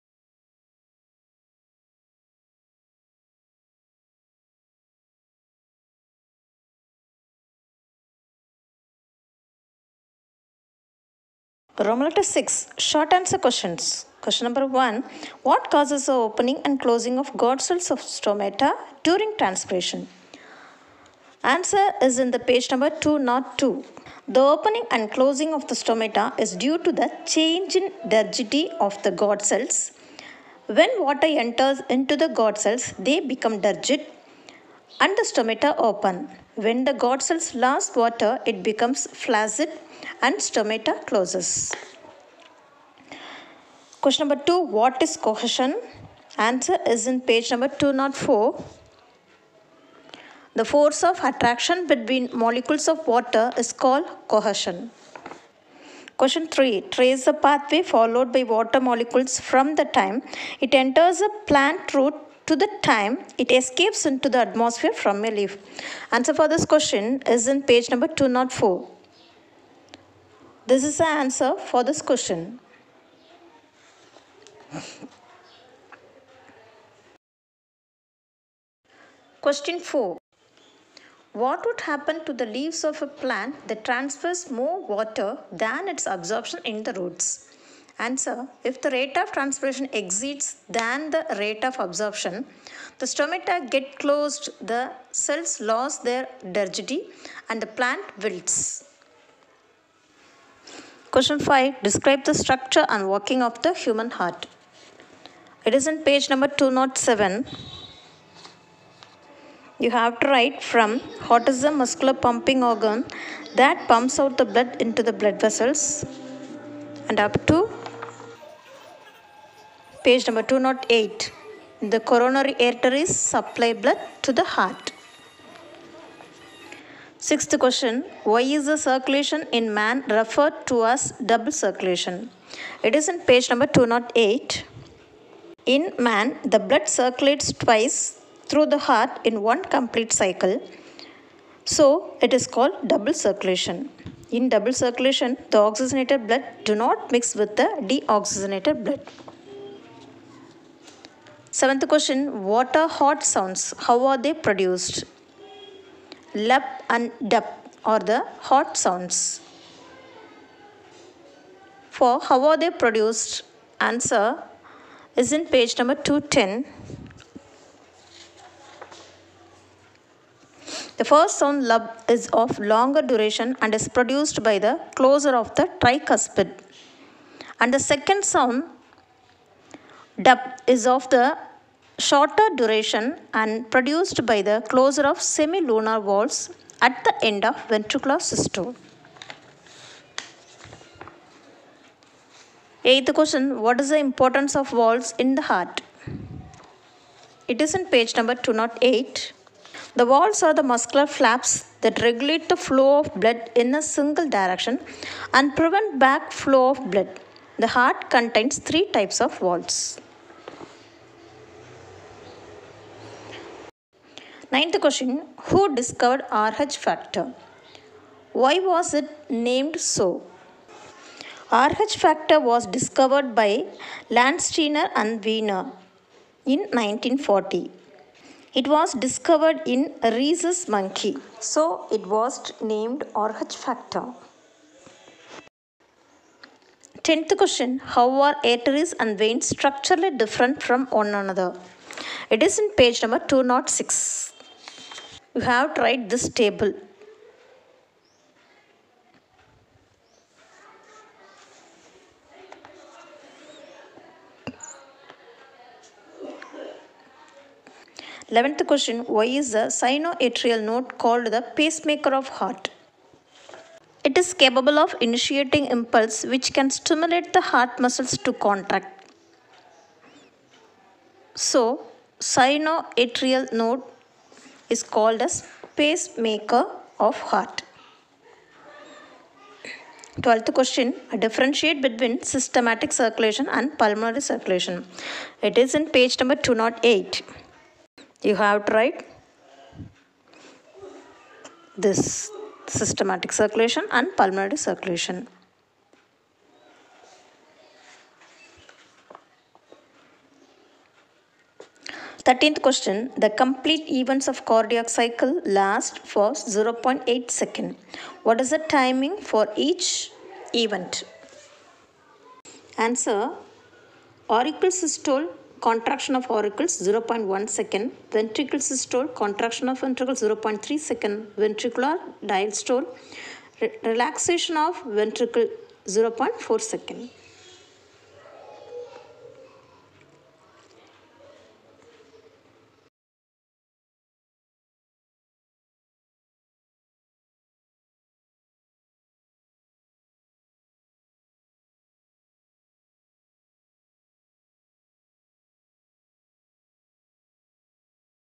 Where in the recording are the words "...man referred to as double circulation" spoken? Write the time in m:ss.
2:09.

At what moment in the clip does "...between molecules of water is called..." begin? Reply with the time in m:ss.
0:51.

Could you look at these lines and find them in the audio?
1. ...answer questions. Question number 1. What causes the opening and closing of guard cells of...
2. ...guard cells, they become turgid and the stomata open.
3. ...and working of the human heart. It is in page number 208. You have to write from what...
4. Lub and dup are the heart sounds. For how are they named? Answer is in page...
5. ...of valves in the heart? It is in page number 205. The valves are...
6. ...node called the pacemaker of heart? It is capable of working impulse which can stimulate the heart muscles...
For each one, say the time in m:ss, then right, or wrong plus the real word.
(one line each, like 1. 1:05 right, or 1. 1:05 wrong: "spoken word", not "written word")
1. 0:13 right
2. 0:32 right
3. 1:42 wrong: "207", not "208"
4. 2:36 wrong: "produced", not "named"
5. 3:14 wrong: "208", not "205"
6. 4:20 wrong: "initiating", not "working".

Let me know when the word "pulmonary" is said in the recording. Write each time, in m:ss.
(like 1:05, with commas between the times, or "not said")
4:43, 4:54.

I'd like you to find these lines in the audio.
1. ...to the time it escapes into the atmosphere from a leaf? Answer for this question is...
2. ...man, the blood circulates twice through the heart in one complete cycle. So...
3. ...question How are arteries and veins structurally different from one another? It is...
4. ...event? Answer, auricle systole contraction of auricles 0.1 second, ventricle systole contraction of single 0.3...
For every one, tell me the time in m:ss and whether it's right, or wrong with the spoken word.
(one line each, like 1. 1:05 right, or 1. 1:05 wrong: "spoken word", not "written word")
1. 1:02 right
2. 2:15 right
3. 3:57 right
4. 5:10 wrong: "ventricle", not "single".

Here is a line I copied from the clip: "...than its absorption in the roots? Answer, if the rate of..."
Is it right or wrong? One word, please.
right.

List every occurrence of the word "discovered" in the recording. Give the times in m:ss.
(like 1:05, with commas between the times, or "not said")
3:35, 3:42, 3:49.